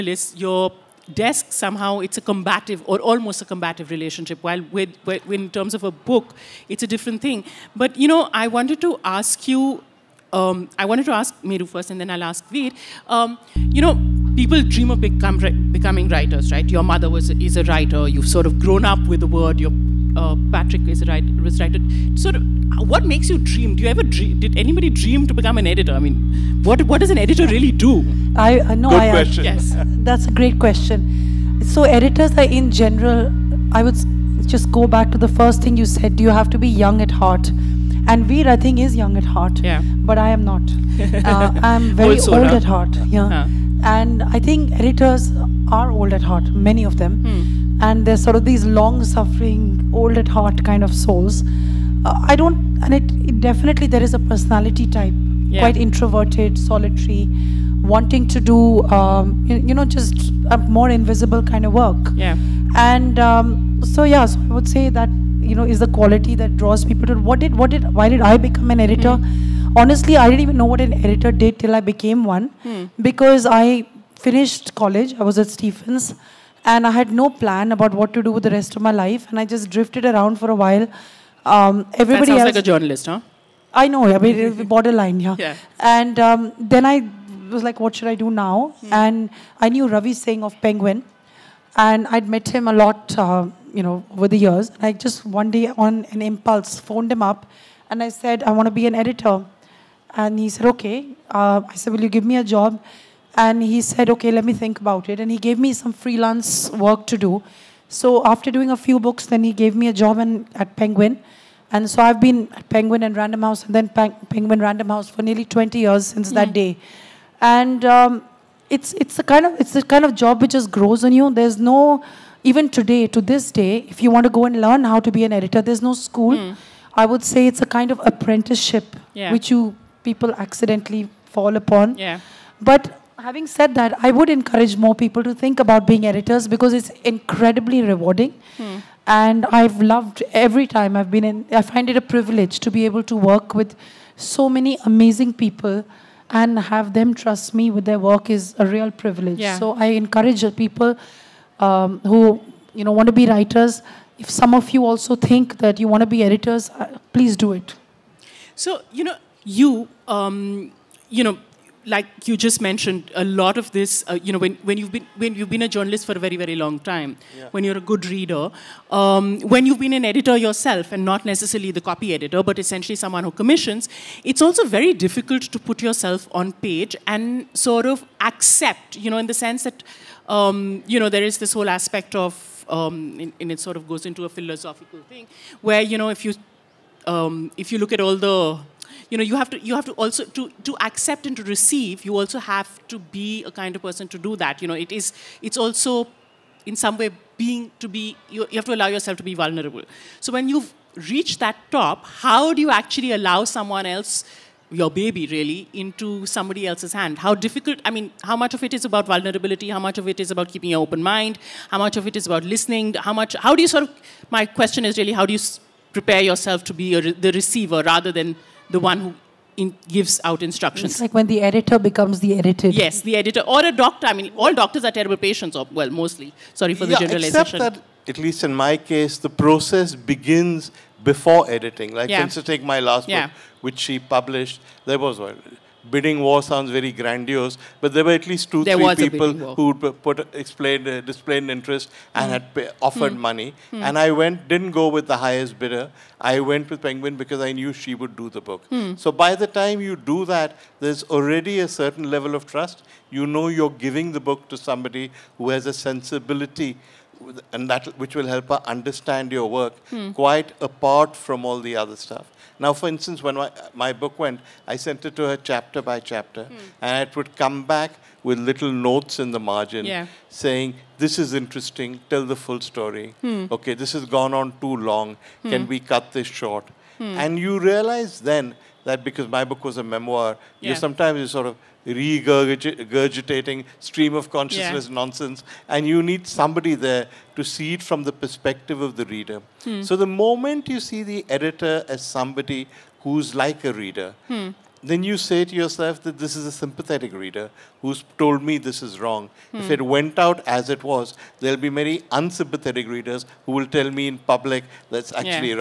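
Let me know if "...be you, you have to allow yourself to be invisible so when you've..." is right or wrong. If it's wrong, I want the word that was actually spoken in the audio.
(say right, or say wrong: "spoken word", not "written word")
wrong: "vulnerable", not "invisible".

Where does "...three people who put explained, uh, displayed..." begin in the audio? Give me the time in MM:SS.
03:58.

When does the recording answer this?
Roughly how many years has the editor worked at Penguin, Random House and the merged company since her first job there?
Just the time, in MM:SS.
01:55.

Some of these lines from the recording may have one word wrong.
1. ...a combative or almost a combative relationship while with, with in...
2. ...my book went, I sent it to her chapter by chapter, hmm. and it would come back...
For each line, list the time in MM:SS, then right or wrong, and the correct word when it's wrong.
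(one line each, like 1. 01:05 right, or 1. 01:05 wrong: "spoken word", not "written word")
1. 00:02 right
2. 04:23 right.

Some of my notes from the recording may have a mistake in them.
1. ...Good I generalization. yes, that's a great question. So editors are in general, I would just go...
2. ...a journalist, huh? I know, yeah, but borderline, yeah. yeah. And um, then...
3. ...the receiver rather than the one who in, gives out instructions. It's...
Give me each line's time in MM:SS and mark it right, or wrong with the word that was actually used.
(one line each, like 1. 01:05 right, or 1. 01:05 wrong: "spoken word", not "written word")
1. 00:28 wrong: "question", not "generalization"
2. 01:22 right
3. 03:37 right.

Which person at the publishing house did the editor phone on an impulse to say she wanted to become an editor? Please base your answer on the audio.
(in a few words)
Ravi Singh.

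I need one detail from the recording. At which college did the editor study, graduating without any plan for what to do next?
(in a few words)
Stephens.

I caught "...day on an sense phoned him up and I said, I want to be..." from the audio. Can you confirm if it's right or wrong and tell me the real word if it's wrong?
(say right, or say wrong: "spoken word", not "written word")
wrong: "impulse", not "sense".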